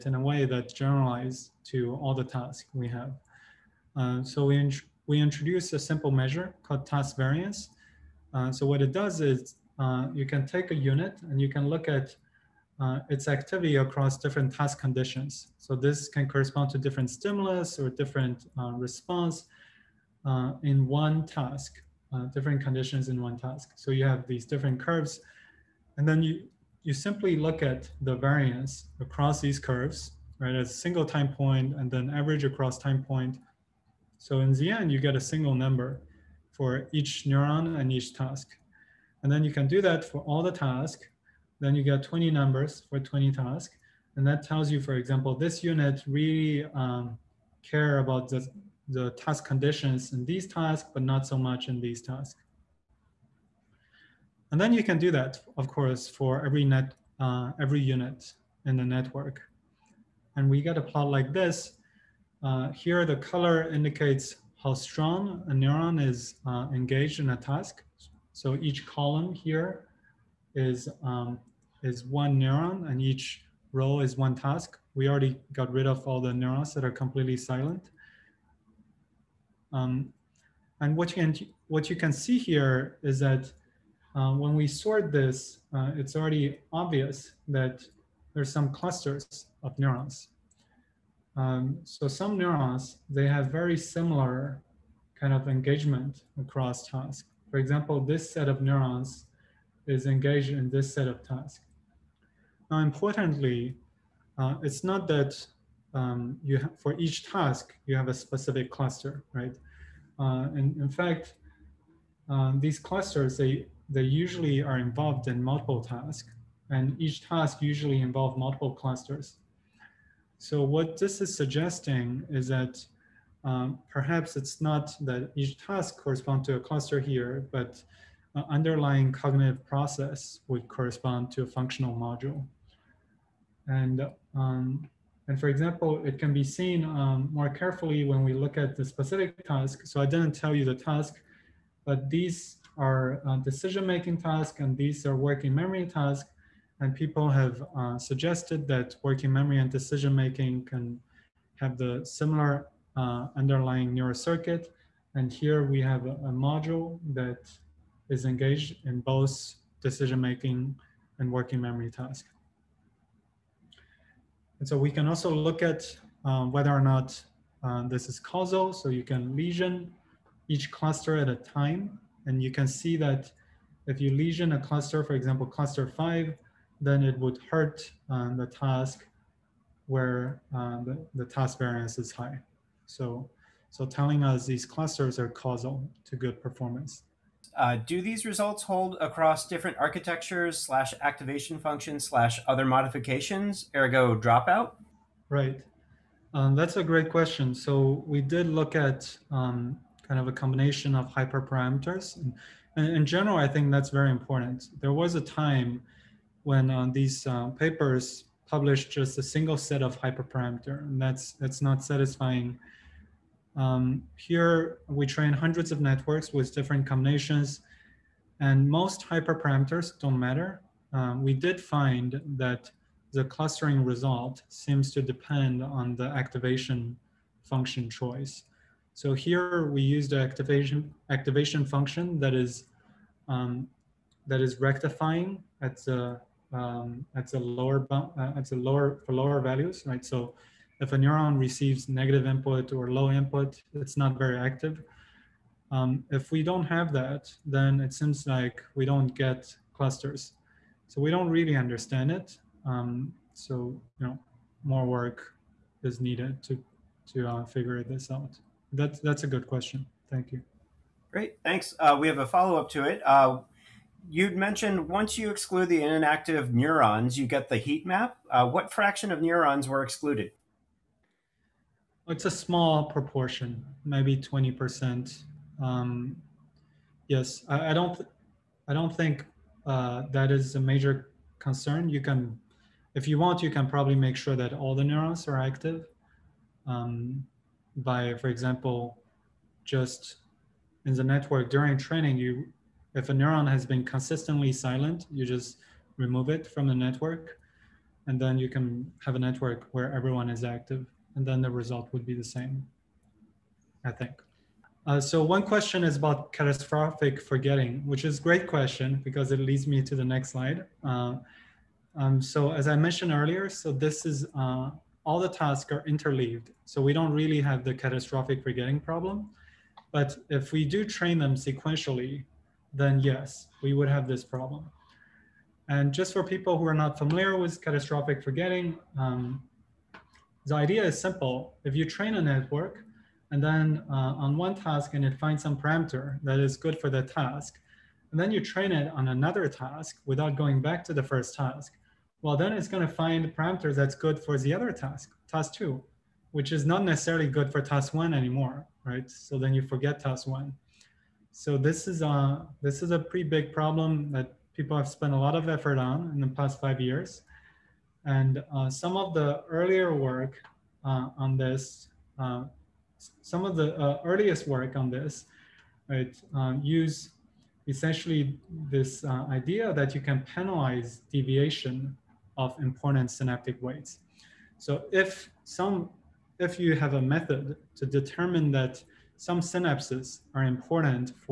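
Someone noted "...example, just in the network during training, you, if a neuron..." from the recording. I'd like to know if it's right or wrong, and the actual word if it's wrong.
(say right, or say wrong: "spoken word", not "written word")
right.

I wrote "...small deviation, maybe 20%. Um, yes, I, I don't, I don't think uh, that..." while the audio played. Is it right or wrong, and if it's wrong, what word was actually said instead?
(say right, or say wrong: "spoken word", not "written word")
wrong: "proportion", not "deviation".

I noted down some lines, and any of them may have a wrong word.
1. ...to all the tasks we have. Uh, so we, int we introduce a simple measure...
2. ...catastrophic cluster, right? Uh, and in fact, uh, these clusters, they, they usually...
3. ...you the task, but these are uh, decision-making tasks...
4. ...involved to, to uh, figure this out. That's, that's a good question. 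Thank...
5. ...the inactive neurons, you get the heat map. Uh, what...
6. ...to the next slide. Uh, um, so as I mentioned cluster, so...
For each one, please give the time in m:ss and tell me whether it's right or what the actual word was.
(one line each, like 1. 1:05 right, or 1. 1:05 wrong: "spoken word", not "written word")
1. 0:01 right
2. 1:48 wrong: "specific", not "catastrophic"
3. 2:20 right
4. 4:16 wrong: "needed", not "involved"
5. 4:25 right
6. 5:09 wrong: "earlier", not "cluster".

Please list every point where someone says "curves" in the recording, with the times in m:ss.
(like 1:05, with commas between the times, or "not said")
0:24, 0:29.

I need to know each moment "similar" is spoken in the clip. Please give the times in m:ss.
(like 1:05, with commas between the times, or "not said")
1:33, 2:32.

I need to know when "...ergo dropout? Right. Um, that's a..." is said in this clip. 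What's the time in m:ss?
3:13.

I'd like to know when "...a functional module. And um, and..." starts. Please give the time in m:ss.
2:11.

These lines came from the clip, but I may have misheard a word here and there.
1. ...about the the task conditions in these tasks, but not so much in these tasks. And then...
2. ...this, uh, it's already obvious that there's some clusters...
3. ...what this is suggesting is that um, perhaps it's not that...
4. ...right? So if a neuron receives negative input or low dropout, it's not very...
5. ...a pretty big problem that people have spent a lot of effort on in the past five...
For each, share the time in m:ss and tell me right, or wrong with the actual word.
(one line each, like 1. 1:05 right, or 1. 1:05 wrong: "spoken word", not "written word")
1. 0:47 right
2. 1:25 right
3. 2:00 right
4. 3:59 wrong: "input", not "dropout"
5. 5:52 right.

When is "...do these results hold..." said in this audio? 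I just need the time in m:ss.
3:07.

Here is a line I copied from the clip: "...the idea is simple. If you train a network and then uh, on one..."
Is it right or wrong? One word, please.
right.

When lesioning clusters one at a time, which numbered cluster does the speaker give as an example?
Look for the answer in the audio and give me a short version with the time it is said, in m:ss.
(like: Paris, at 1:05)
cluster 5, at 2:55.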